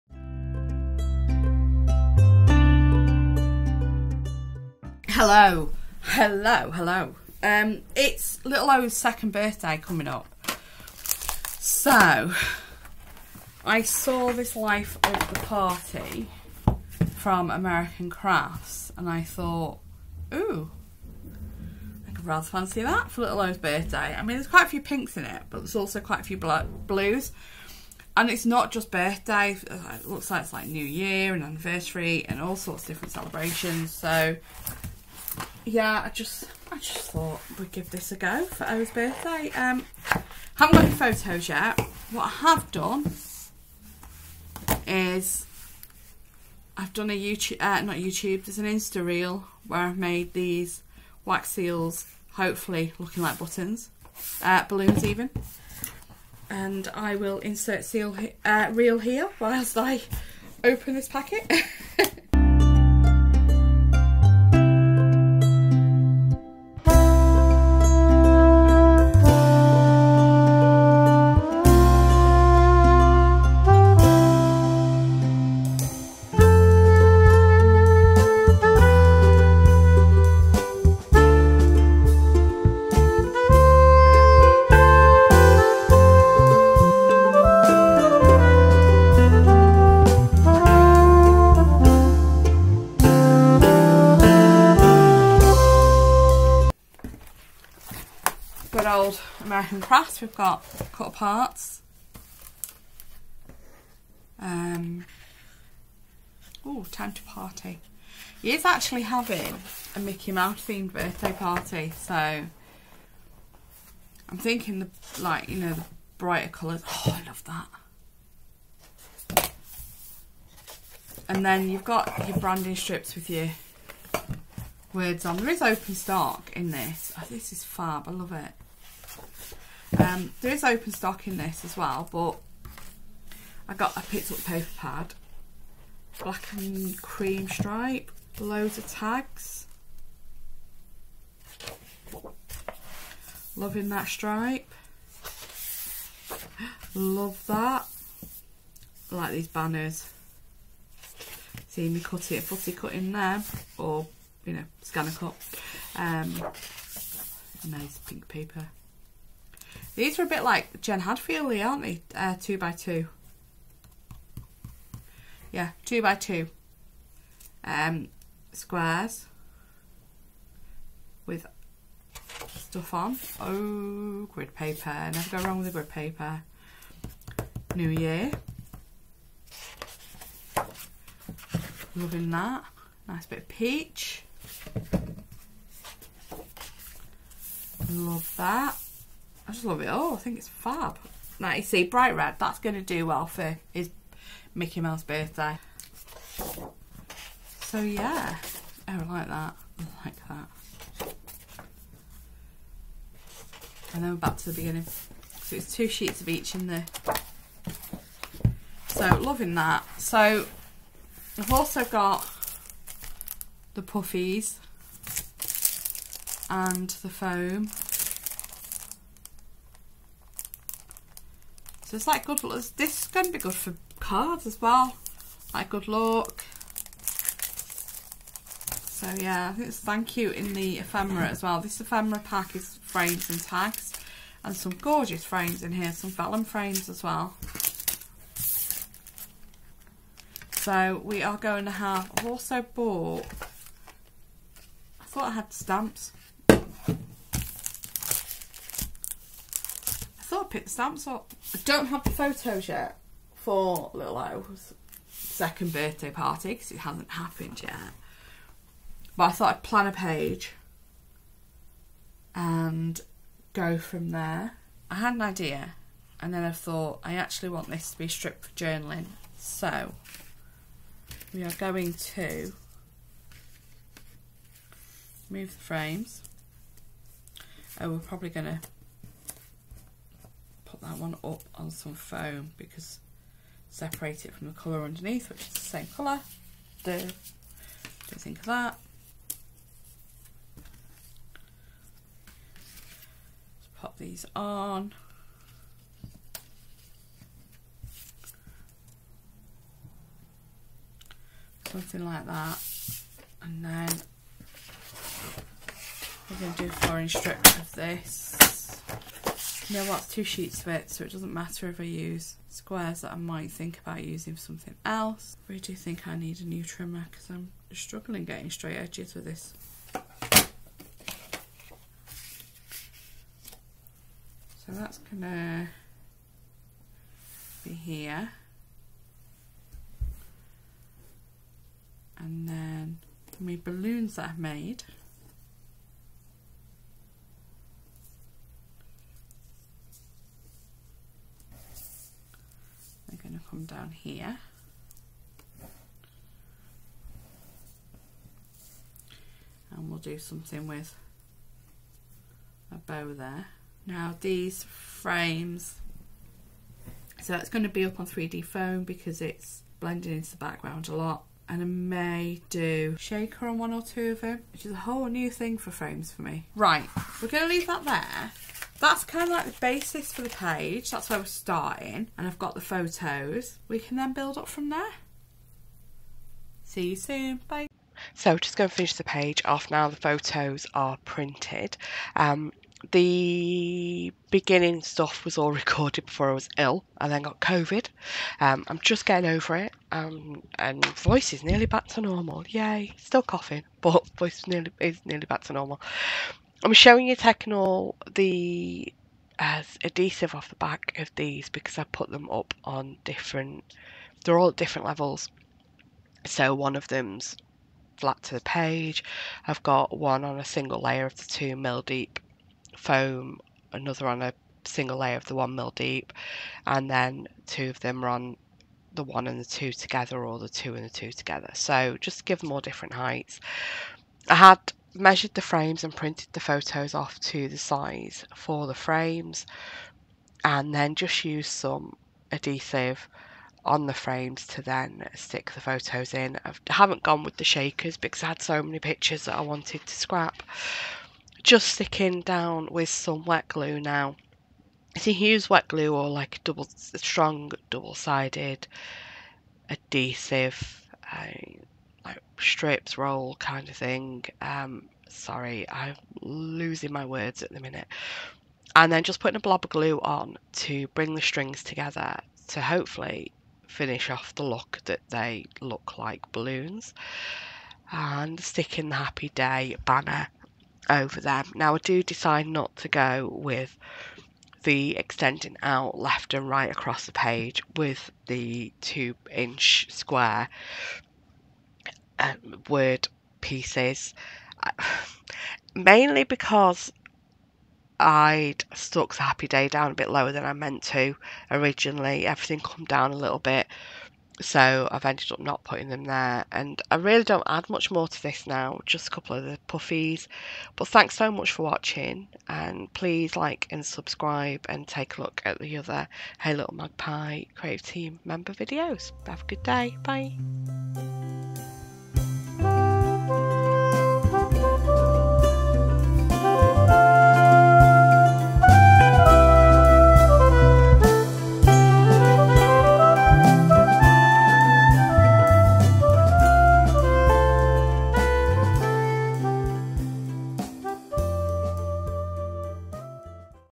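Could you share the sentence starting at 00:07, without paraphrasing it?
Um, it's little O's second birthday coming up.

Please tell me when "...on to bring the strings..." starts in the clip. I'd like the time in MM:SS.
07:39.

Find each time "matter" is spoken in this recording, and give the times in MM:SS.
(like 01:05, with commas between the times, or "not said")
05:11.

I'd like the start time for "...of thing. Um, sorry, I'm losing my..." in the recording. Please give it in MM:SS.
07:33.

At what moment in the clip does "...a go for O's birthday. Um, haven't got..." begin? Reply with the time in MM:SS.
00:38.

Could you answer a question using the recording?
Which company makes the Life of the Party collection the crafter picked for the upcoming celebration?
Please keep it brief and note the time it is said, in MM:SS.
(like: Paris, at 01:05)
American Crafts, at 00:17.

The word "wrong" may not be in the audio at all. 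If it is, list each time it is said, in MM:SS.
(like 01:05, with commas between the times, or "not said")
02:55.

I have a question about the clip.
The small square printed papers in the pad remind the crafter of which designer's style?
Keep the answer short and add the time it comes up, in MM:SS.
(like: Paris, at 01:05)
Jen Hadfield, at 02:40.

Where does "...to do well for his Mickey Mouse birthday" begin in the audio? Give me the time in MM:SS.
03:12.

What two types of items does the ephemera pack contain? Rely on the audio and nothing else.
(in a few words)
frames and tags.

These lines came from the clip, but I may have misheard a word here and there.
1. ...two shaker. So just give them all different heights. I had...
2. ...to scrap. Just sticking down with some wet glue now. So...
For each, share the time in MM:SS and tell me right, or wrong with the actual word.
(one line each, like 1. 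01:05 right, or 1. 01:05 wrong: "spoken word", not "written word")
1. 07:00 wrong: "together", not "shaker"
2. 07:19 right.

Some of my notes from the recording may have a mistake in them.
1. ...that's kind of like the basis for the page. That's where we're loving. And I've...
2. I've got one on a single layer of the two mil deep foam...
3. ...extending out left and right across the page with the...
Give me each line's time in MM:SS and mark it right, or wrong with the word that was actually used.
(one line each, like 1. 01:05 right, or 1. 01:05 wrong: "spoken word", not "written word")
1. 06:08 wrong: "starting", not "loving"
2. 06:49 right
3. 07:54 right.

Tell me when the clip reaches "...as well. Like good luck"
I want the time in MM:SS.
03:44.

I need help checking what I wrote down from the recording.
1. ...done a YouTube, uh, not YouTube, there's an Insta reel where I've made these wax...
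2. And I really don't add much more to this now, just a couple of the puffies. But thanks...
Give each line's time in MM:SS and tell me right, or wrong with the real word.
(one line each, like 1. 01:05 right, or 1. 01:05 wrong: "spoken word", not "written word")
1. 00:46 right
2. 08:16 right.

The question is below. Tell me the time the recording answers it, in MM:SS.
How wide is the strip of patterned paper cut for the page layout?
05:06.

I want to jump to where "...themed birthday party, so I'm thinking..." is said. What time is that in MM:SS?
01:50.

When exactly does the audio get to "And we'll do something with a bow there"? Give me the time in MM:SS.
05:49.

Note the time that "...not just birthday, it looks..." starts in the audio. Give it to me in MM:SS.
00:28.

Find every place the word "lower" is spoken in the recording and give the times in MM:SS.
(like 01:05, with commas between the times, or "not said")
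08:10.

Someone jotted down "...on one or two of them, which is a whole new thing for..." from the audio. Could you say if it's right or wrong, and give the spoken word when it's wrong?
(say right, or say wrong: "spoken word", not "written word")
right.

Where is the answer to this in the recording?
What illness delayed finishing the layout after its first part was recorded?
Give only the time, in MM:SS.
06:27.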